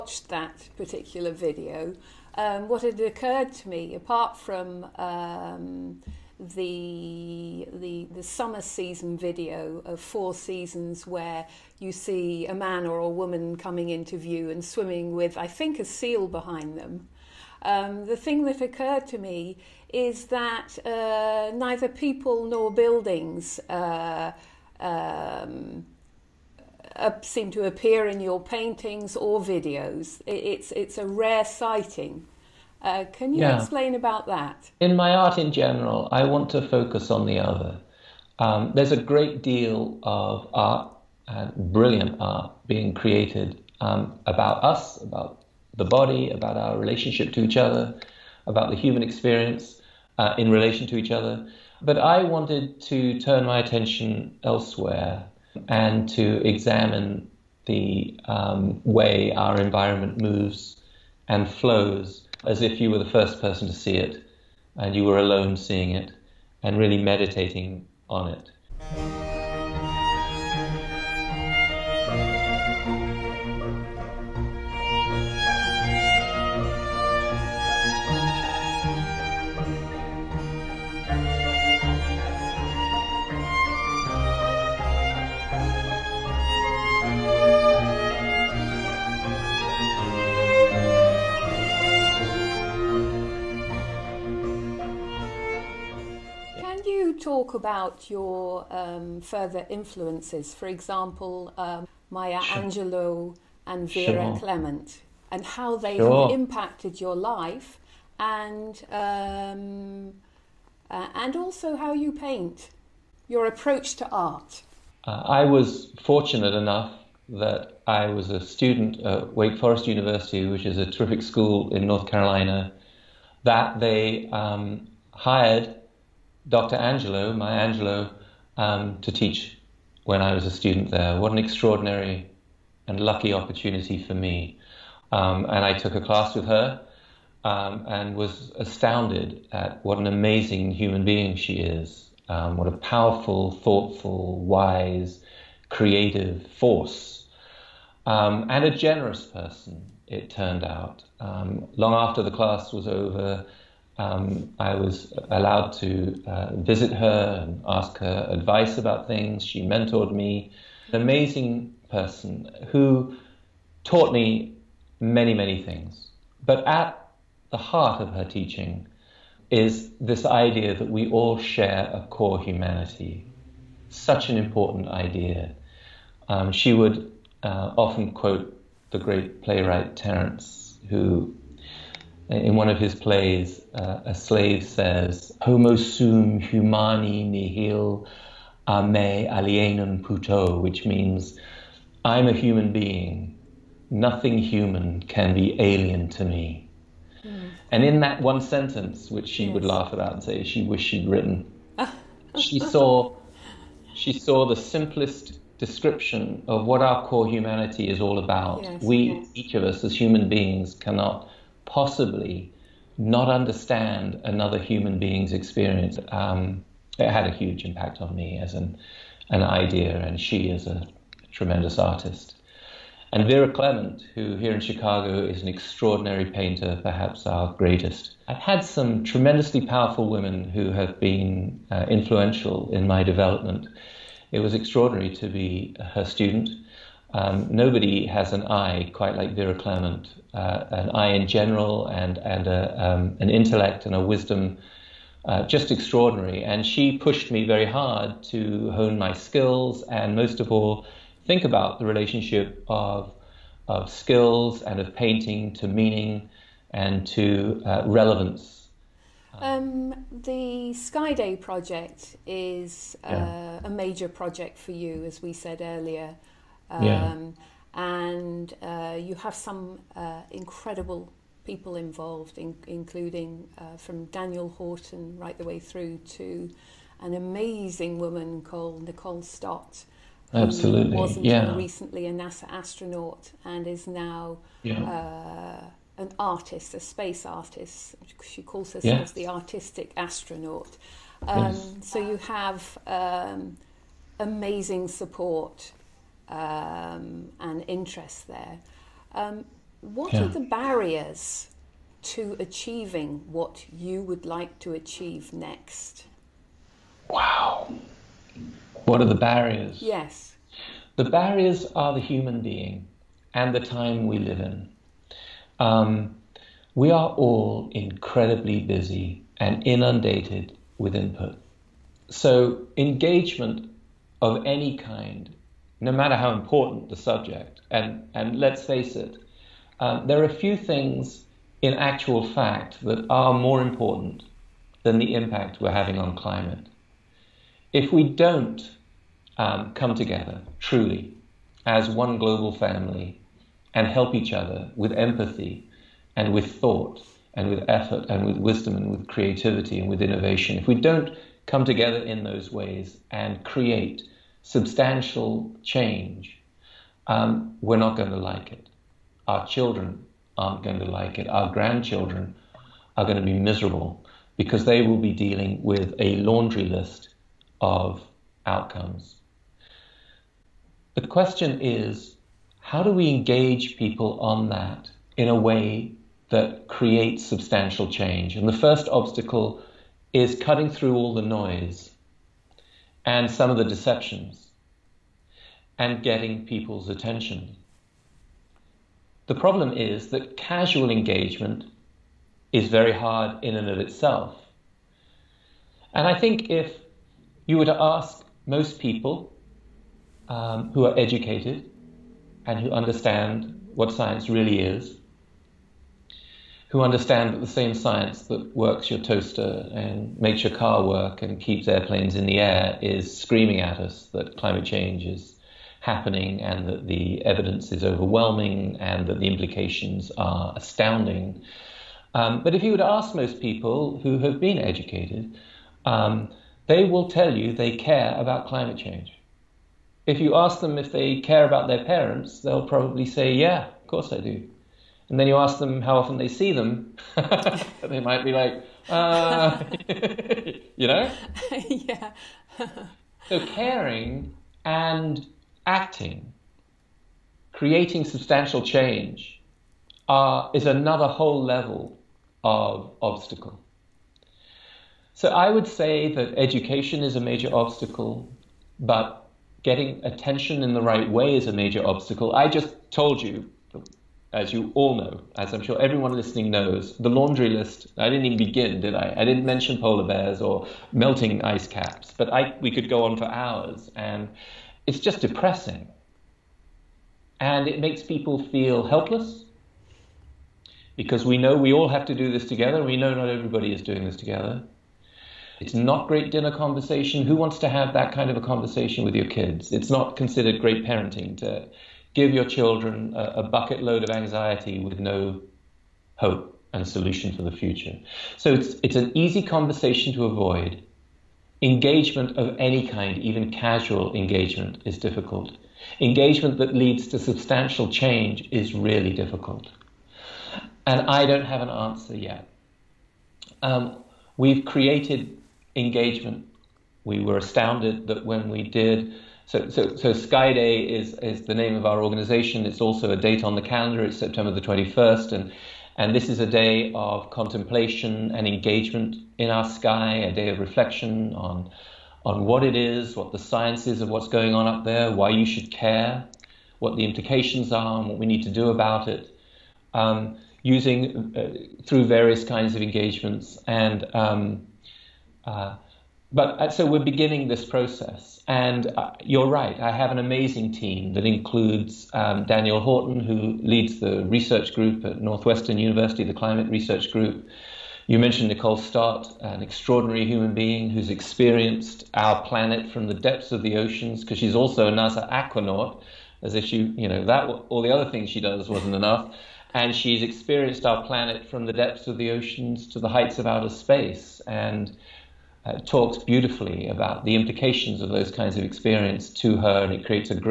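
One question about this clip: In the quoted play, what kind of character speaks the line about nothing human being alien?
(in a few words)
A slave.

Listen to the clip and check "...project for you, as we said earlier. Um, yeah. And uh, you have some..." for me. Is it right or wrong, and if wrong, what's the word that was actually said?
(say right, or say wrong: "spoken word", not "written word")
right.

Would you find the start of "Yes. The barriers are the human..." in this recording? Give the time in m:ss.
5:09.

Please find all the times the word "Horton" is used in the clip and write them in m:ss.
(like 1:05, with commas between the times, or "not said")
4:34, 9:12.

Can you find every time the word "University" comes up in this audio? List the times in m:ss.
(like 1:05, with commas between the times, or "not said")
1:59, 9:15.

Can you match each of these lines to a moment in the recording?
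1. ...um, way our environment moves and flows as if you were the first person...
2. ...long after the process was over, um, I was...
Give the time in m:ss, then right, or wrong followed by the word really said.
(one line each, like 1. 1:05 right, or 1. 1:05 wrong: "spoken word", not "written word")
1. 0:58 right
2. 2:31 wrong: "class", not "process".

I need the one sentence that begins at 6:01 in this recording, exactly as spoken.
Our grandchildren are going to be miserable because they will be dealing with a laundry list of outcomes.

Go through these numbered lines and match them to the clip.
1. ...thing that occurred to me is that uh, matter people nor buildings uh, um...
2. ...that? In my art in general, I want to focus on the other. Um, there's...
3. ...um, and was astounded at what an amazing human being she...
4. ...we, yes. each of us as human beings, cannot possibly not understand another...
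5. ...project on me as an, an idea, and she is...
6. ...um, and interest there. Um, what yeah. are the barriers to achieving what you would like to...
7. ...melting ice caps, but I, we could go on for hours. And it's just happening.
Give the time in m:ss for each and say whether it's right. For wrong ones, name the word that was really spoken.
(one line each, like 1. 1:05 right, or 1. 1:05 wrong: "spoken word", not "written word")
1. 0:18 wrong: "neither", not "matter"
2. 0:34 right
3. 2:17 right
4. 3:28 right
5. 3:37 wrong: "impact", not "project"
6. 4:56 right
7. 7:50 wrong: "depressing", not "happening".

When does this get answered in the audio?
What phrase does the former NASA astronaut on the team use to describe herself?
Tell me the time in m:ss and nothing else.
4:49.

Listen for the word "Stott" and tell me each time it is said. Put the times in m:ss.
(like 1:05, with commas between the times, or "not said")
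4:39, 9:18.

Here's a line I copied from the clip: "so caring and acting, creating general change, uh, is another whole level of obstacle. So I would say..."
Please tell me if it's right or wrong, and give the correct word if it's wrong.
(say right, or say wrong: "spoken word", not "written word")
wrong: "substantial", not "general".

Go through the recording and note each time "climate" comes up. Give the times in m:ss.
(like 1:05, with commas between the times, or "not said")
5:36, 6:54, 7:08, 9:16.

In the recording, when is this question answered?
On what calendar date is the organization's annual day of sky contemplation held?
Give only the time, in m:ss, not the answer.
8:44.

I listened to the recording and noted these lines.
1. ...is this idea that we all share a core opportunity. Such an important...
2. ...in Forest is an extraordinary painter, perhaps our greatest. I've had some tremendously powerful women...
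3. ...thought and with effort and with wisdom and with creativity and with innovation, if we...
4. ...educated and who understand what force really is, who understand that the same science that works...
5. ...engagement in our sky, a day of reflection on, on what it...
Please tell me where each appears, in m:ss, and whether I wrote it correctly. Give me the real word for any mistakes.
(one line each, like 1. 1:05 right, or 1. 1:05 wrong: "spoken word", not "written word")
1. 2:49 wrong: "humanity", not "opportunity"
2. 3:44 wrong: "Chicago", not "Forest"
3. 5:46 right
4. 6:40 wrong: "science", not "force"
5. 8:48 right.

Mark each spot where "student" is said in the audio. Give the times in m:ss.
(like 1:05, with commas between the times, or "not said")
1:58, 2:10, 3:56.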